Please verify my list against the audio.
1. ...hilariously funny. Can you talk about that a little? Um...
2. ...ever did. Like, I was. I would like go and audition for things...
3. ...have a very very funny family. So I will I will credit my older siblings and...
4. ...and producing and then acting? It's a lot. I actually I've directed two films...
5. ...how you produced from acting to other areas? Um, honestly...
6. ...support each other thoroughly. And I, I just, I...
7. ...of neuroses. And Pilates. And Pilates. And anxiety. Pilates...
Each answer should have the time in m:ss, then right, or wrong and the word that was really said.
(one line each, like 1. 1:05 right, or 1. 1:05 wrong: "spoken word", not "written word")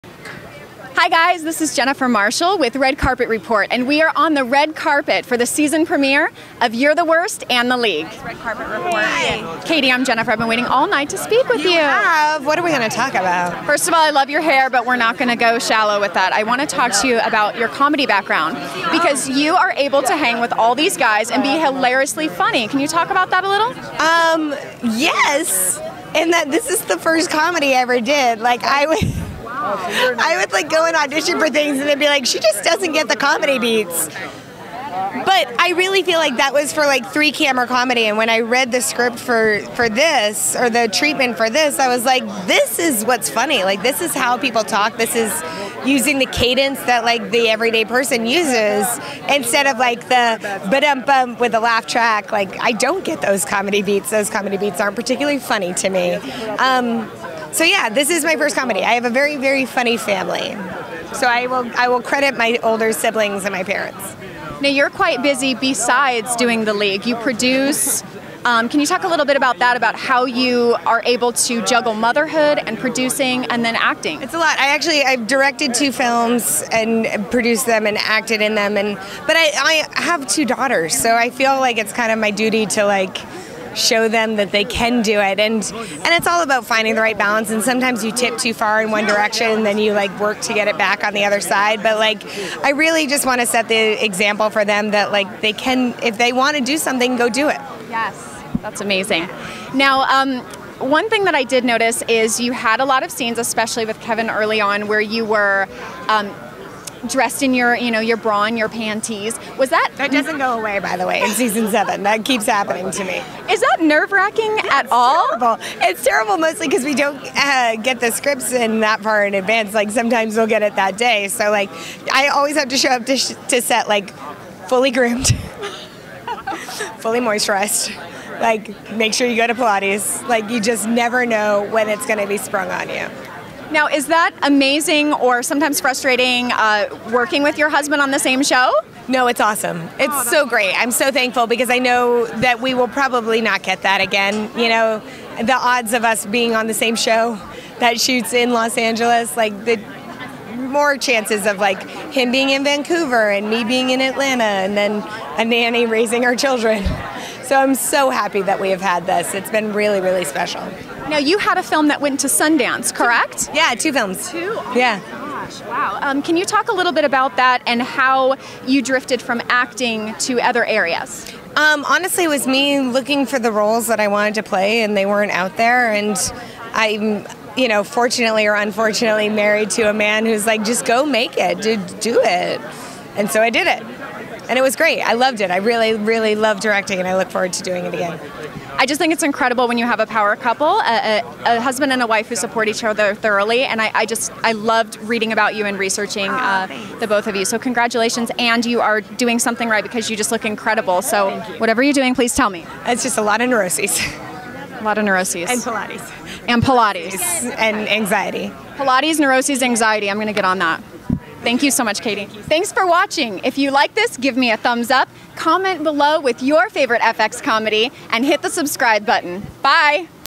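1. 0:21 right
2. 0:27 right
3. 0:58 right
4. 1:12 right
5. 2:47 wrong: "drifted", not "produced"
6. 3:12 right
7. 3:24 right.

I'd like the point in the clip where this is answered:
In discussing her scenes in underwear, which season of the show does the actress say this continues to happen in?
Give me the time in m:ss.
1:51.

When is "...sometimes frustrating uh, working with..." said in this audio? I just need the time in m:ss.
2:15.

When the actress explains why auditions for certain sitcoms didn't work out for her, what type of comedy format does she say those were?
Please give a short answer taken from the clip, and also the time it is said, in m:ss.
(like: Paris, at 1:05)
three camera comedy, at 0:37.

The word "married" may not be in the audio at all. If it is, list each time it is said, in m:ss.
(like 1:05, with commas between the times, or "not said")
2:59.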